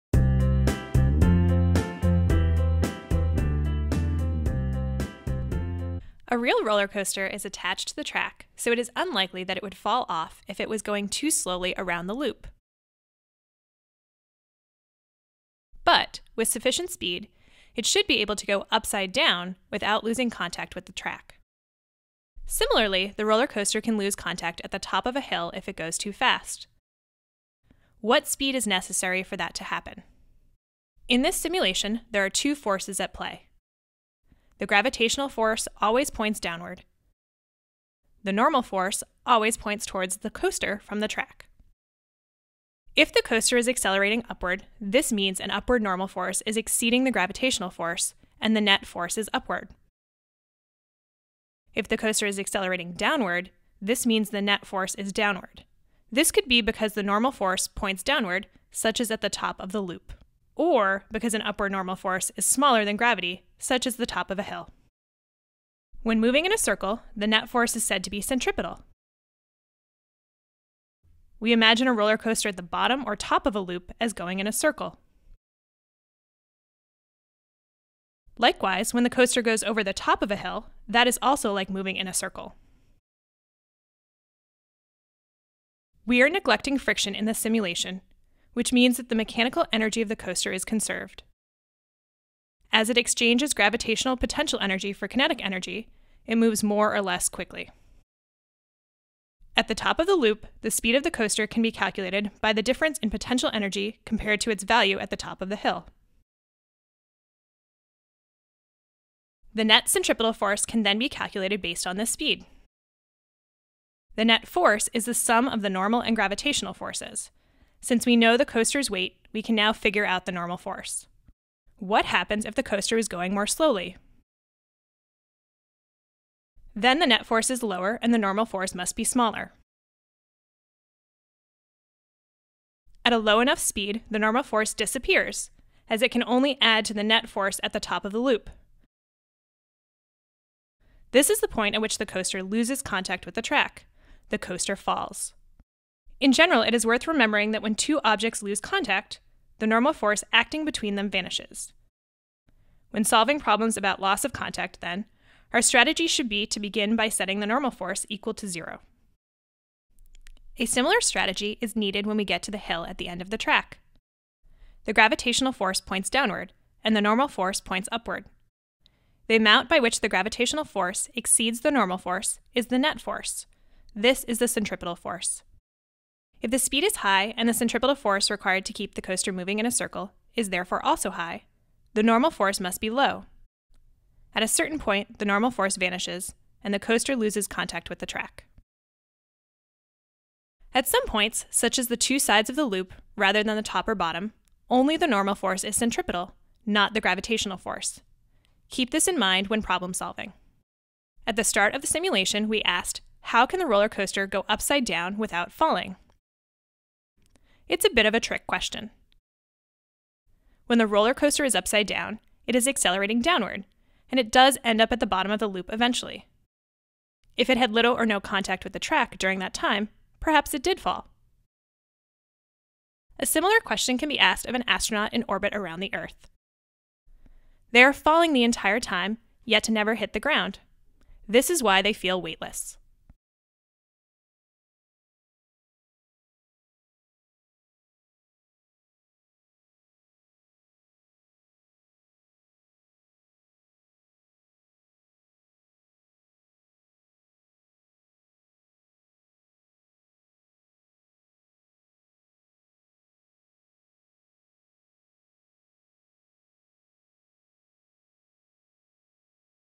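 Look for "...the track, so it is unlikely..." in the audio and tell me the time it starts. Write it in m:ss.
0:07.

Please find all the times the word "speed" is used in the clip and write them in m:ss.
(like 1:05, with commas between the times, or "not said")
0:16, 0:28, 1:40, 1:52, 2:13, 2:56.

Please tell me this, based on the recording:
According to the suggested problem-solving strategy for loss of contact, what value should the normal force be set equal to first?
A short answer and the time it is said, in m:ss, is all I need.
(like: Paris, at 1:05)
0, at 2:38.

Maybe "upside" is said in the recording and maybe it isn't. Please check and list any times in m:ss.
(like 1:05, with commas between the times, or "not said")
0:18, 3:24, 3:31.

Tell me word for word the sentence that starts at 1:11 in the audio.
We imagine a roller coaster at the bottom or top of a loop as going in a circle.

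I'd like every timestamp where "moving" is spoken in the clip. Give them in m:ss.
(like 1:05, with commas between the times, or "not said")
1:06, 1:21, 2:59.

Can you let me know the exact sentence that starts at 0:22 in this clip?
Similarly, the roller coaster can lose contact at the top of a hill if it goes too fast.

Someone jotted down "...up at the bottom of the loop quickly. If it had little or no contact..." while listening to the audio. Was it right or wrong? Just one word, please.
wrong.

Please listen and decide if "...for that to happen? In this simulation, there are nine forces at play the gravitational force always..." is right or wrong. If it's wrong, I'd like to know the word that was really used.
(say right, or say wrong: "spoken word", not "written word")
wrong: "two", not "nine".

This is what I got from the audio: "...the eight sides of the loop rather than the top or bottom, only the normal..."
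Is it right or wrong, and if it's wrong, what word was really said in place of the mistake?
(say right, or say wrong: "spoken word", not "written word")
wrong: "two", not "eight".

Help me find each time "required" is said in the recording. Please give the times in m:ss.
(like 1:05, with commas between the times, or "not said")
2:58.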